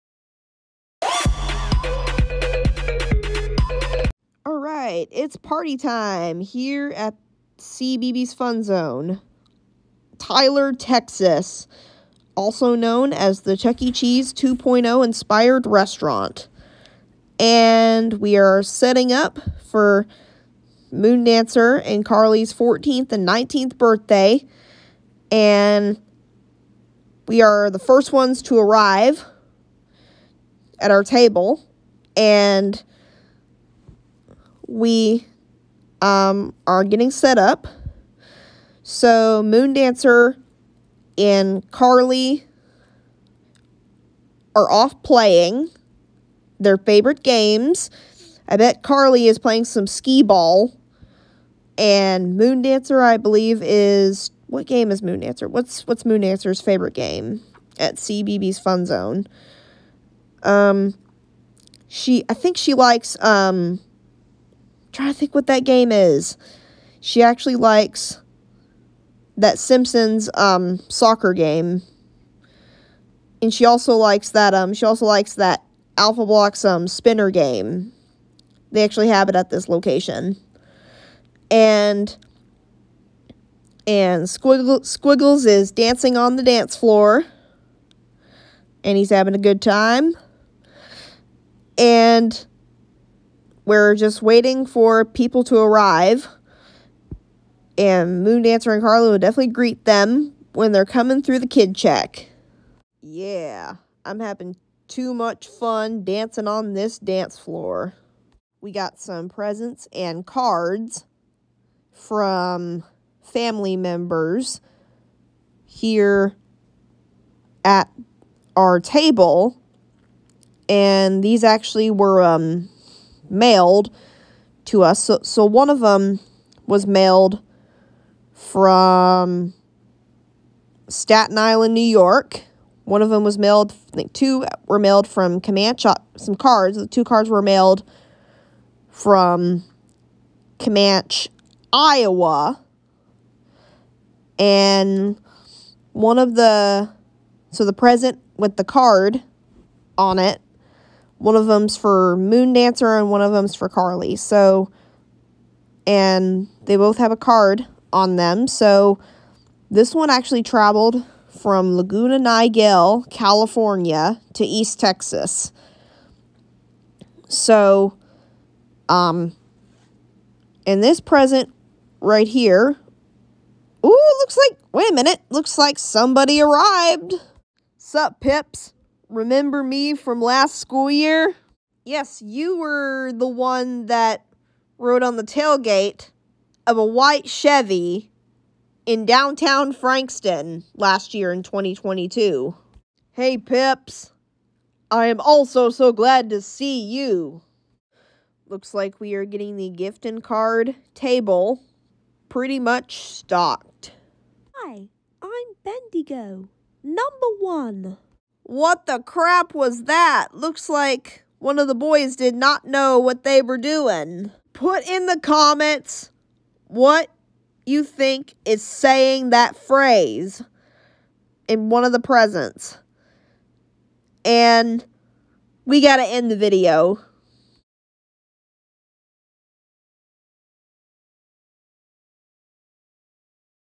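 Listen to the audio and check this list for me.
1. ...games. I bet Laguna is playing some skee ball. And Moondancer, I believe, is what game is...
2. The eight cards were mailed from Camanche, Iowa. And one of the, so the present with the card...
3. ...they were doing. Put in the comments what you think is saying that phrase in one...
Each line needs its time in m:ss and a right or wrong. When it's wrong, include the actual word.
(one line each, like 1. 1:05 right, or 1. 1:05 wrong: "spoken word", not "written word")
1. 0:47 wrong: "Carly", not "Laguna"
2. 2:16 wrong: "two", not "eight"
3. 3:33 right.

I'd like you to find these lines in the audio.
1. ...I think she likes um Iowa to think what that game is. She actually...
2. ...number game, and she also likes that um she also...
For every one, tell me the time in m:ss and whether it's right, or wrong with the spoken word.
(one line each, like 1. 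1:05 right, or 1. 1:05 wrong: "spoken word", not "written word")
1. 1:02 wrong: "Try", not "Iowa"
2. 1:10 wrong: "soccer", not "number".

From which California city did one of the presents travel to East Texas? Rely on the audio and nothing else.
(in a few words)
Laguna Niguel.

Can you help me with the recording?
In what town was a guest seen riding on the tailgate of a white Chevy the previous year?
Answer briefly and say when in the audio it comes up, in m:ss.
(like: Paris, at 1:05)
Frankston, at 3:09.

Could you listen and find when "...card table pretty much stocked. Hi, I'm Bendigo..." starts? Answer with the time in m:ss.
3:20.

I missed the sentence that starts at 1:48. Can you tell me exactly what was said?
We got some presents and cards from family members here at our table.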